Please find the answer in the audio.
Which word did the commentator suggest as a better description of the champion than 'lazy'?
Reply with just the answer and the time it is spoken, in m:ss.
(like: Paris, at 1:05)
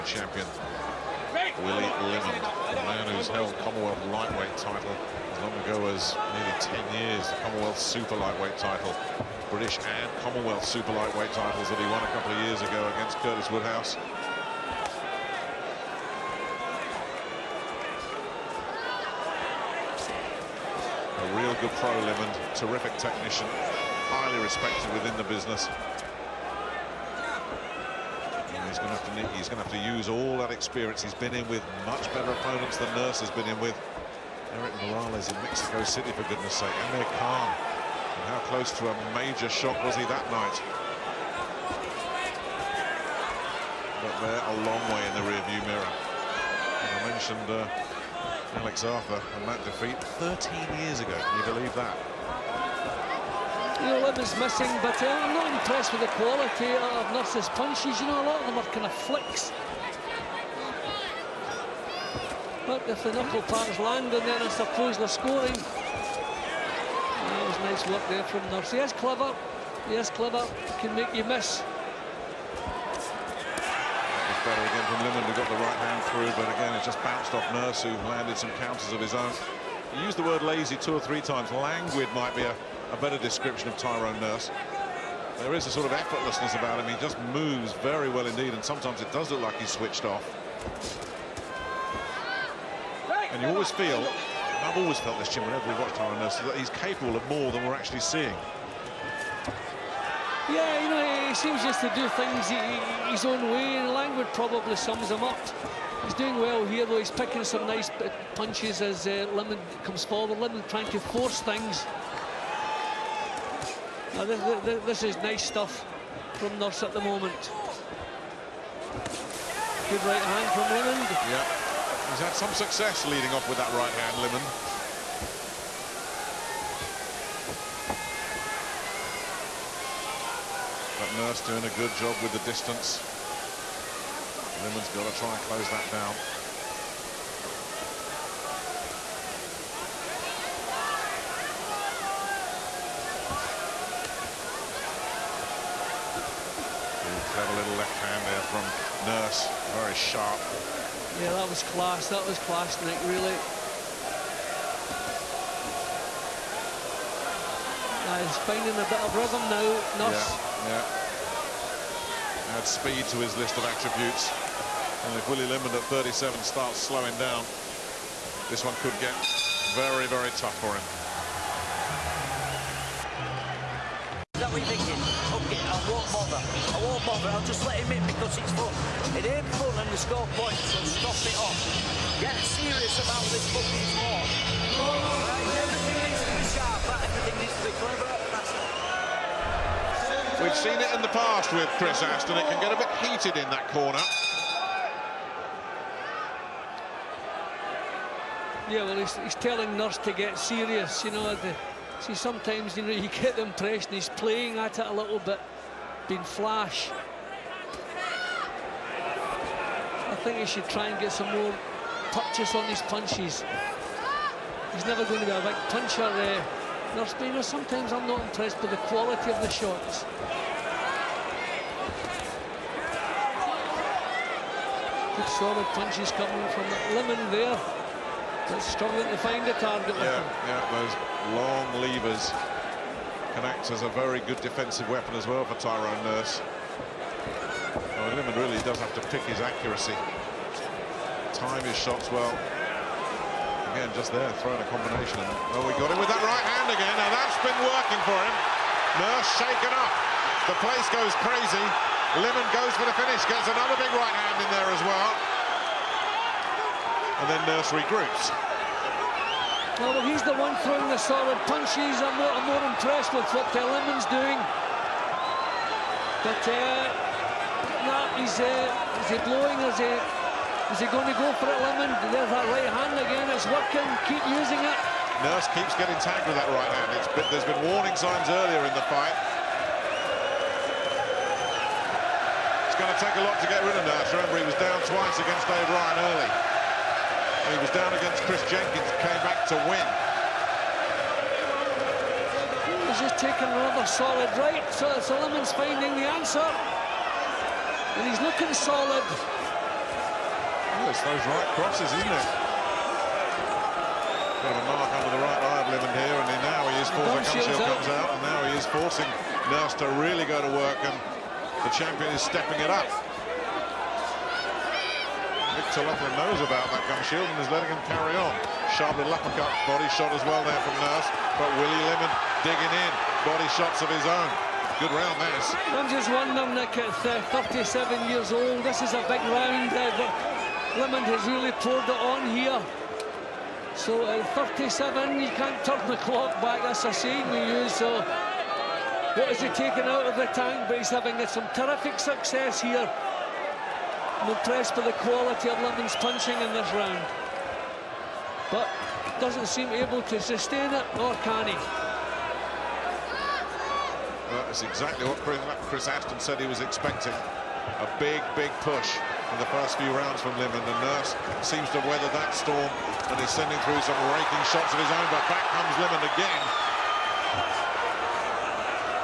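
Languid, at 1:21.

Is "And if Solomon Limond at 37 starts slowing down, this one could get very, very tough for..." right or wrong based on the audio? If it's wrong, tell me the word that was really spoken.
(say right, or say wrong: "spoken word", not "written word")
wrong: "Willie", not "Solomon".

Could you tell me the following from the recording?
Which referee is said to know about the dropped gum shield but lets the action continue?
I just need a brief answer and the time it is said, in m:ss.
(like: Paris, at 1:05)
Victor Loughlin, at 5:15.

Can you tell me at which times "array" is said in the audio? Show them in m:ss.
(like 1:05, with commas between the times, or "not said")
not said.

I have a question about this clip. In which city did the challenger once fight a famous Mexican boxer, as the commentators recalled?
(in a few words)
Mexico City.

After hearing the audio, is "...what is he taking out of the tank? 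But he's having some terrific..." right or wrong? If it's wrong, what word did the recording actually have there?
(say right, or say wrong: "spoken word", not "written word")
right.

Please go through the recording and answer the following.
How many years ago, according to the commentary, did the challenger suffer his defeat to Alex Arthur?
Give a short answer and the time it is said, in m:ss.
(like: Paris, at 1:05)
13, at 0:50.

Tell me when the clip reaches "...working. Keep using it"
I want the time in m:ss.
4:33.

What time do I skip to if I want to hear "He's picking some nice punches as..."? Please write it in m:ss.
1:46.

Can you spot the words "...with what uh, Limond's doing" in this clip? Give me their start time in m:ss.
4:23.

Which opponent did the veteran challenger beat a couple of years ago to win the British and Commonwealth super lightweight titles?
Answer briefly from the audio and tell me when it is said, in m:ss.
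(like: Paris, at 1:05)
Curtis Woodhouse, at 0:13.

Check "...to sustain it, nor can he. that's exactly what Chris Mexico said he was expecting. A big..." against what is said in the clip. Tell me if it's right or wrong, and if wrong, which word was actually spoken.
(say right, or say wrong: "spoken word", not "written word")
wrong: "Aston", not "Mexico".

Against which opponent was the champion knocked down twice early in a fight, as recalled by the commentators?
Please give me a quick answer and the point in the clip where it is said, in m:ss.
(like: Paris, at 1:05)
Dave Ryan, at 4:45.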